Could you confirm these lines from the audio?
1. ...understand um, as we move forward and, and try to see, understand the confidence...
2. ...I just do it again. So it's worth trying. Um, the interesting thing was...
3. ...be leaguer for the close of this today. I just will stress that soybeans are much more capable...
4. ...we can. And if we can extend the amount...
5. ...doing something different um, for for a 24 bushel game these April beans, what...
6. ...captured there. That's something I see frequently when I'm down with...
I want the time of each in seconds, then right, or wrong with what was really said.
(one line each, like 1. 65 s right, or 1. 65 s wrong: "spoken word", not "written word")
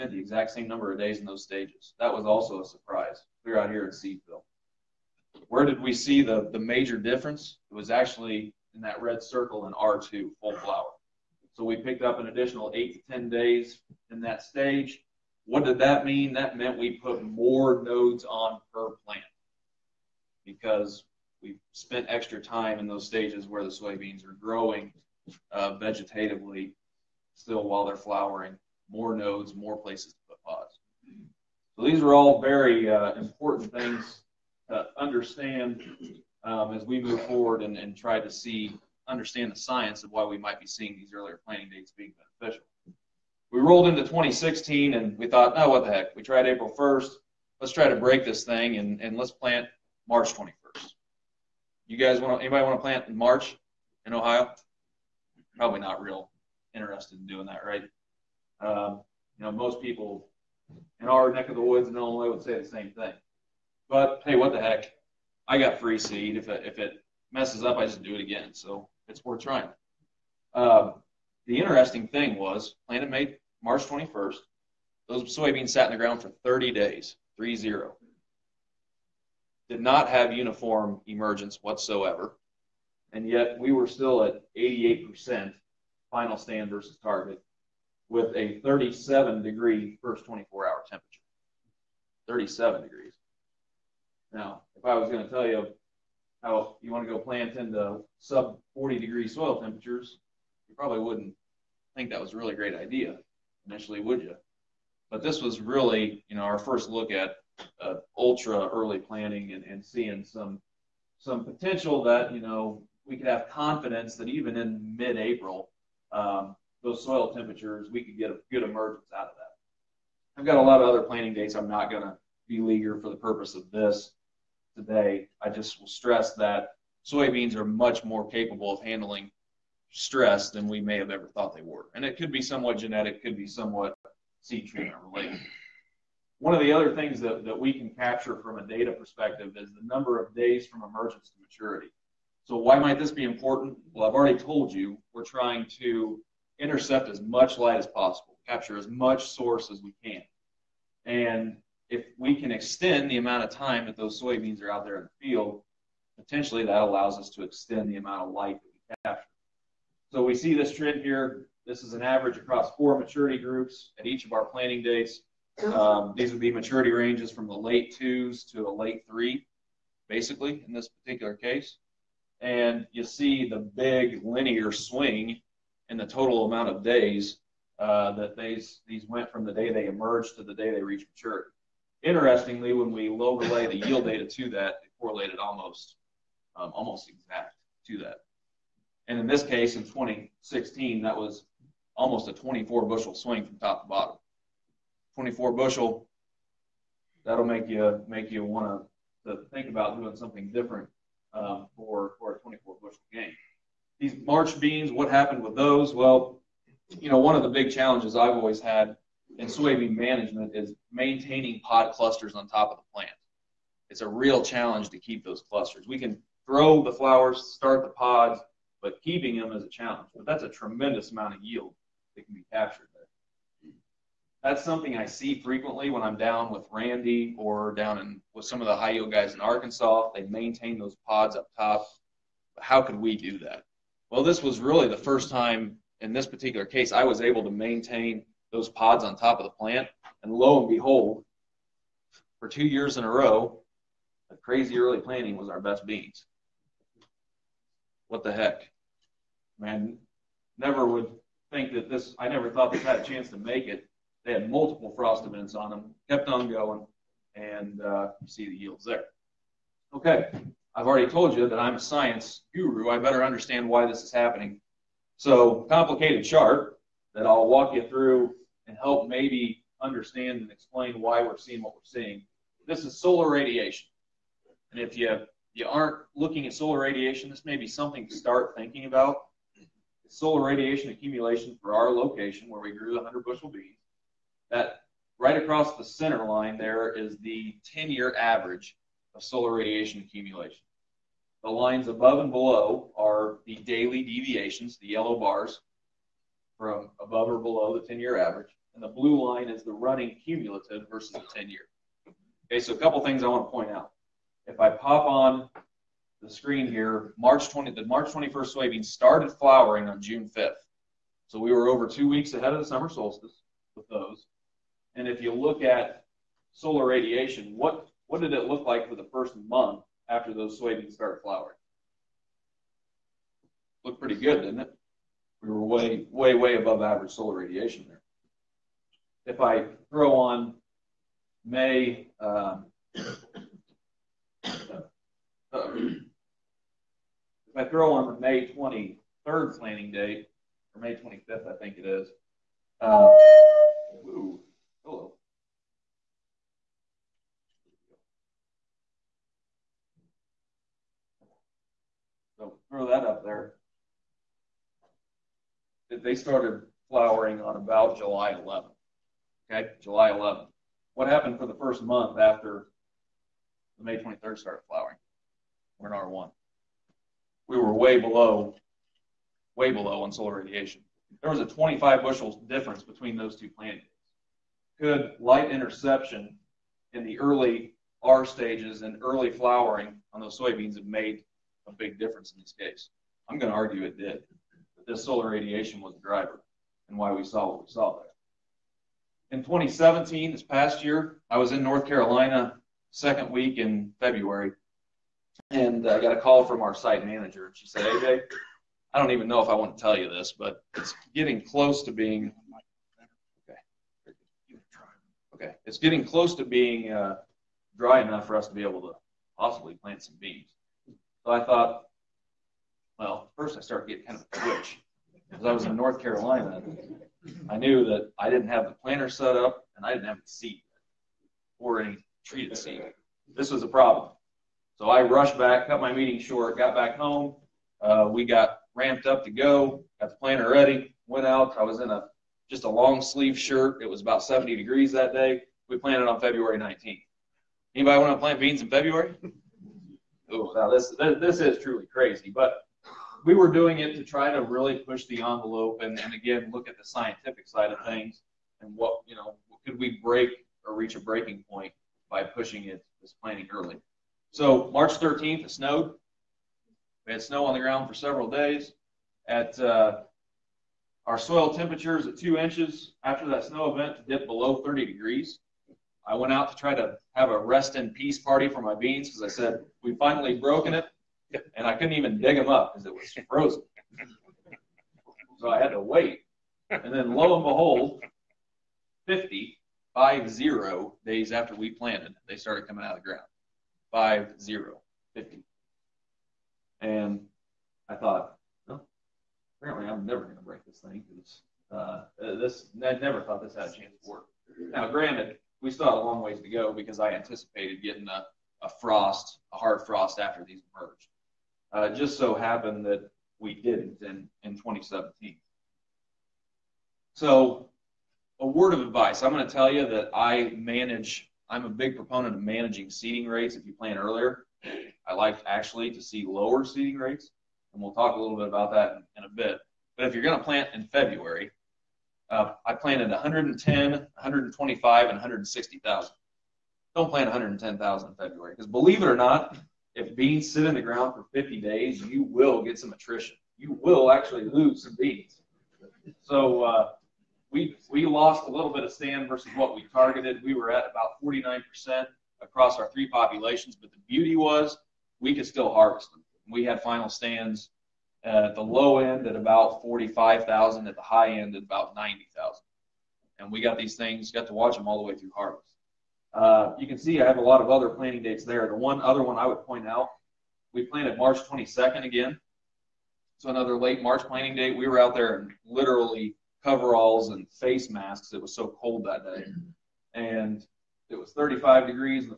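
1. 34 s wrong: "science", not "confidence"
2. 67 s right
3. 122 s wrong: "purpose", not "close"
4. 149 s right
5. 199 s wrong: "March", not "April"
6. 222 s right.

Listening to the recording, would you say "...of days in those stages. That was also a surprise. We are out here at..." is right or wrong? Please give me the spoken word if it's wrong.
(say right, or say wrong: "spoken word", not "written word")
right.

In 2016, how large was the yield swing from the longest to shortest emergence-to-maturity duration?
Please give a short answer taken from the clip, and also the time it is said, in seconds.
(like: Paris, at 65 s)
24 bushel, at 192 s.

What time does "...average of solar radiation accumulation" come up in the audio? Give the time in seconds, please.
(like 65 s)
288 s.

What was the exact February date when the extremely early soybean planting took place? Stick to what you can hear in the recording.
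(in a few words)
February 19th.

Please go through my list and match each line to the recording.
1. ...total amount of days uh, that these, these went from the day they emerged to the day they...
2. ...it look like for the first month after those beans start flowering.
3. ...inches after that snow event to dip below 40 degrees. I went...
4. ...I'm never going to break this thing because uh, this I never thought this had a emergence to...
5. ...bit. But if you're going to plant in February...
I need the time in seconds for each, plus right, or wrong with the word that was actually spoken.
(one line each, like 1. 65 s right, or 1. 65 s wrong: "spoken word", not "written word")
1. 176 s right
2. 318 s wrong: "soybeans", not "beans"
3. 462 s wrong: "30", not "40"
4. 489 s wrong: "chance", not "emergence"
5. 519 s right.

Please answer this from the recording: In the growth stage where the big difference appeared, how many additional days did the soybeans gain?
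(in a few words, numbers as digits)
8 to 10.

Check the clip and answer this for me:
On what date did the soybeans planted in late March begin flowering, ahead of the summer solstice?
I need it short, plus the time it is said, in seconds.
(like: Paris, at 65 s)
June 5th, at 310 s.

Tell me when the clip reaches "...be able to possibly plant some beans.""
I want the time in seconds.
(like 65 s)
408 s.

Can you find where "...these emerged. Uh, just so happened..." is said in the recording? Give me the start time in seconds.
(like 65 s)
500 s.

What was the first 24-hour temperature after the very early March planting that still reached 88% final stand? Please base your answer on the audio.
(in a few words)
37 degrees.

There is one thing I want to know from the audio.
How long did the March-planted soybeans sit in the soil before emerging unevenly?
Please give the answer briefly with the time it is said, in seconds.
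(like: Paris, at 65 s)
30 days, at 76 s.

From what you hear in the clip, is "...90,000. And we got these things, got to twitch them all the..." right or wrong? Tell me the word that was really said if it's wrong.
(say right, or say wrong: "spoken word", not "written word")
wrong: "watch", not "twitch".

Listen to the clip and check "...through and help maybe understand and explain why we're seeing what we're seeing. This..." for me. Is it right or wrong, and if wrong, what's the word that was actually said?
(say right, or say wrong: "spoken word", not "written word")
right.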